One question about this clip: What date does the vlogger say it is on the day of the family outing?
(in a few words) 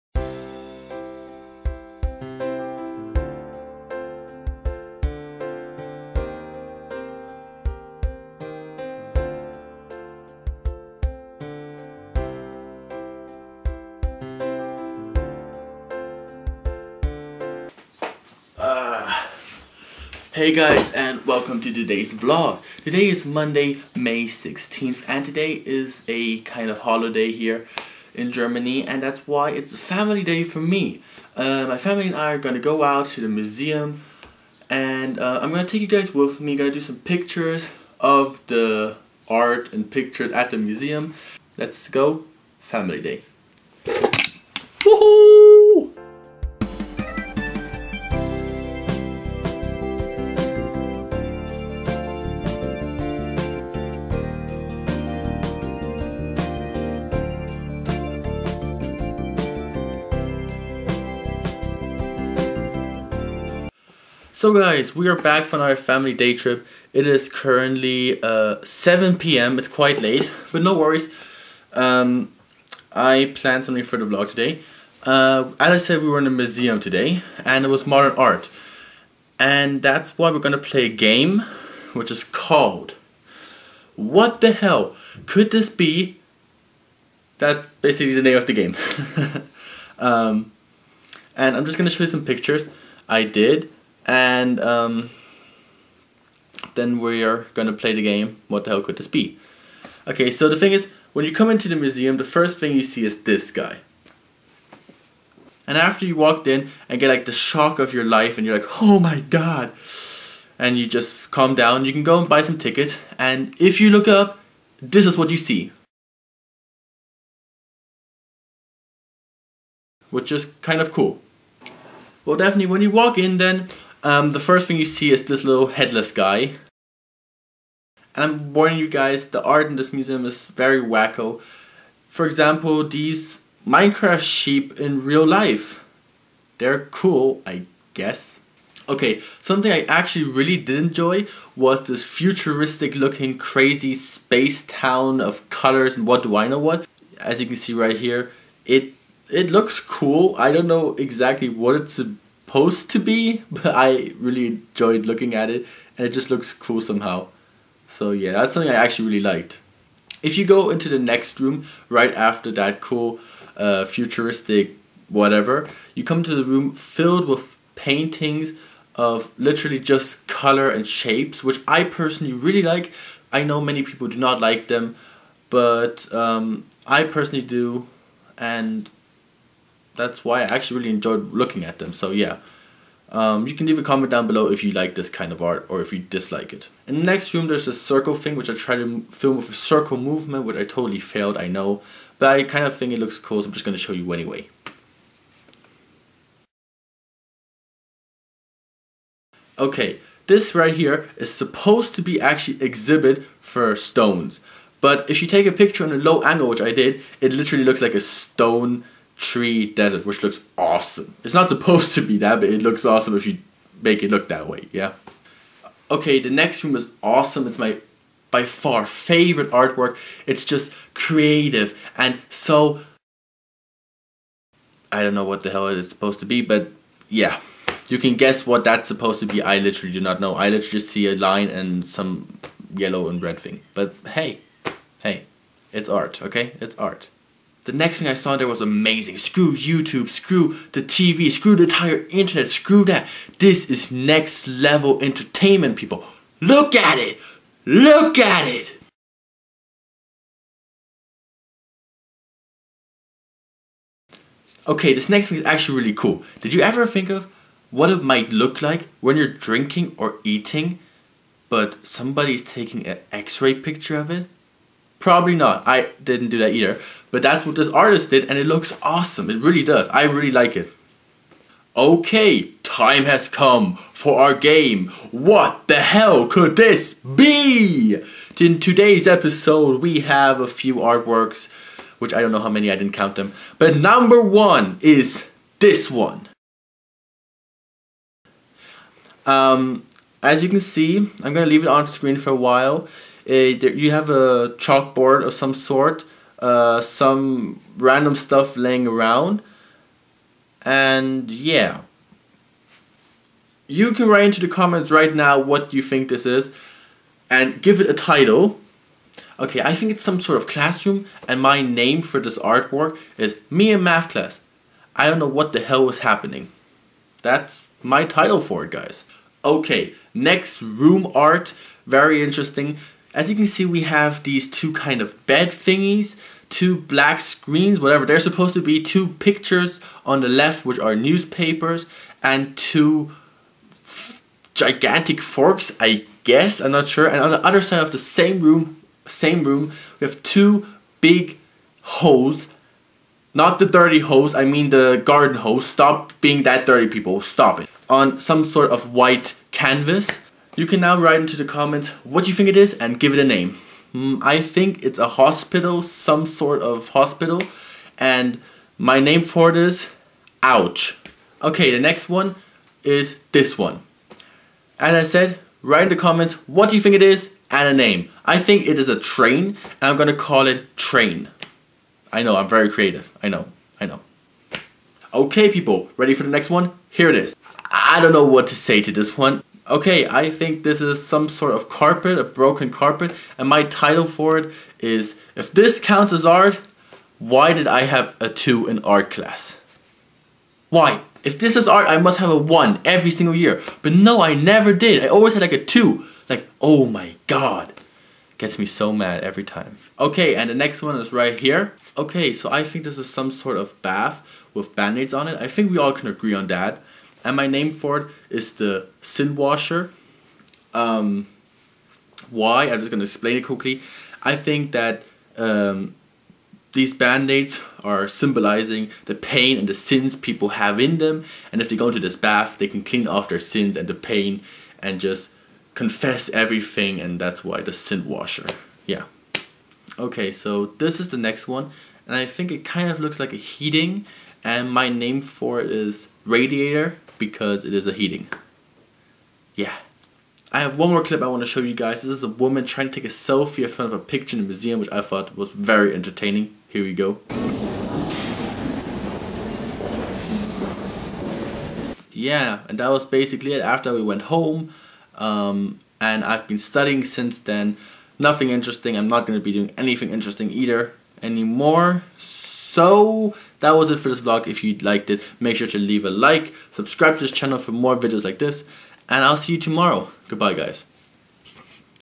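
Monday, May 16th.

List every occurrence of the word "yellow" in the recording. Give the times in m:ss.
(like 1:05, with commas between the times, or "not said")
3:52.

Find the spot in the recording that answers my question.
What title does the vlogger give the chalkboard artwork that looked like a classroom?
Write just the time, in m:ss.
5:13.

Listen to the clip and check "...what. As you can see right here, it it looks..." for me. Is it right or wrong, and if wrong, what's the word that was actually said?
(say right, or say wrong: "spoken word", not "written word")
right.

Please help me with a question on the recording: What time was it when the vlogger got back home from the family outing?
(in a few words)
7 p.m.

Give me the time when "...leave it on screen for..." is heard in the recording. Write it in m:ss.
4:51.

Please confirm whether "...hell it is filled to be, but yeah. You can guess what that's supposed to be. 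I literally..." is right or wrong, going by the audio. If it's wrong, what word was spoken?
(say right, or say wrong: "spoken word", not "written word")
wrong: "supposed", not "filled".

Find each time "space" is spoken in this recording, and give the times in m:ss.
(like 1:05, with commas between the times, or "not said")
2:23.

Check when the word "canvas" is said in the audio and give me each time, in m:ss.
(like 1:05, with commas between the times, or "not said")
5:49.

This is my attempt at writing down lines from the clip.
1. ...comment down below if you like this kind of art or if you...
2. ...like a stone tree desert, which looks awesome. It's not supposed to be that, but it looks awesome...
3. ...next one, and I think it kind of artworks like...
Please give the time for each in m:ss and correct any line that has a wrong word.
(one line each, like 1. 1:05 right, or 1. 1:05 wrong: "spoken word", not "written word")
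1. 3:03 right
2. 3:27 right
3. 7:11 wrong: "looks", not "artworks".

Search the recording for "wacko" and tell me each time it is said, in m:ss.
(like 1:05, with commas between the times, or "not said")
2:10.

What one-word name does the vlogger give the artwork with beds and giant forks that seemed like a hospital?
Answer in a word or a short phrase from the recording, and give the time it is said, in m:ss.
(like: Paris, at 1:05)
Ouch, at 6:00.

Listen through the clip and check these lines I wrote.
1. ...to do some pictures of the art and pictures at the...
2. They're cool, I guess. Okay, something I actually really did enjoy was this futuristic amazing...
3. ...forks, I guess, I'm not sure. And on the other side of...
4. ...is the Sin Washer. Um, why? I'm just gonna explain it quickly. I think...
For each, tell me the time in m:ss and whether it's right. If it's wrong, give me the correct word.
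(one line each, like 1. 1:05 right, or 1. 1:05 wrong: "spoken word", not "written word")
1. 0:36 right
2. 2:16 wrong: "looking", not "amazing"
3. 5:35 right
4. 6:48 right.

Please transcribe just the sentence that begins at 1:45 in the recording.
And after you walked in and get like the shock of your life and you're like, oh my god.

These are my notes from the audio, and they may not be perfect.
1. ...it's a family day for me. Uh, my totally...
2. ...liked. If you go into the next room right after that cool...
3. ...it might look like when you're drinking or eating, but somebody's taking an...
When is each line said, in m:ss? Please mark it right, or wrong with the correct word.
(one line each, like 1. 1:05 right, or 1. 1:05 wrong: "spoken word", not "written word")
1. 0:29 wrong: "family", not "totally"
2. 2:39 right
3. 4:17 right.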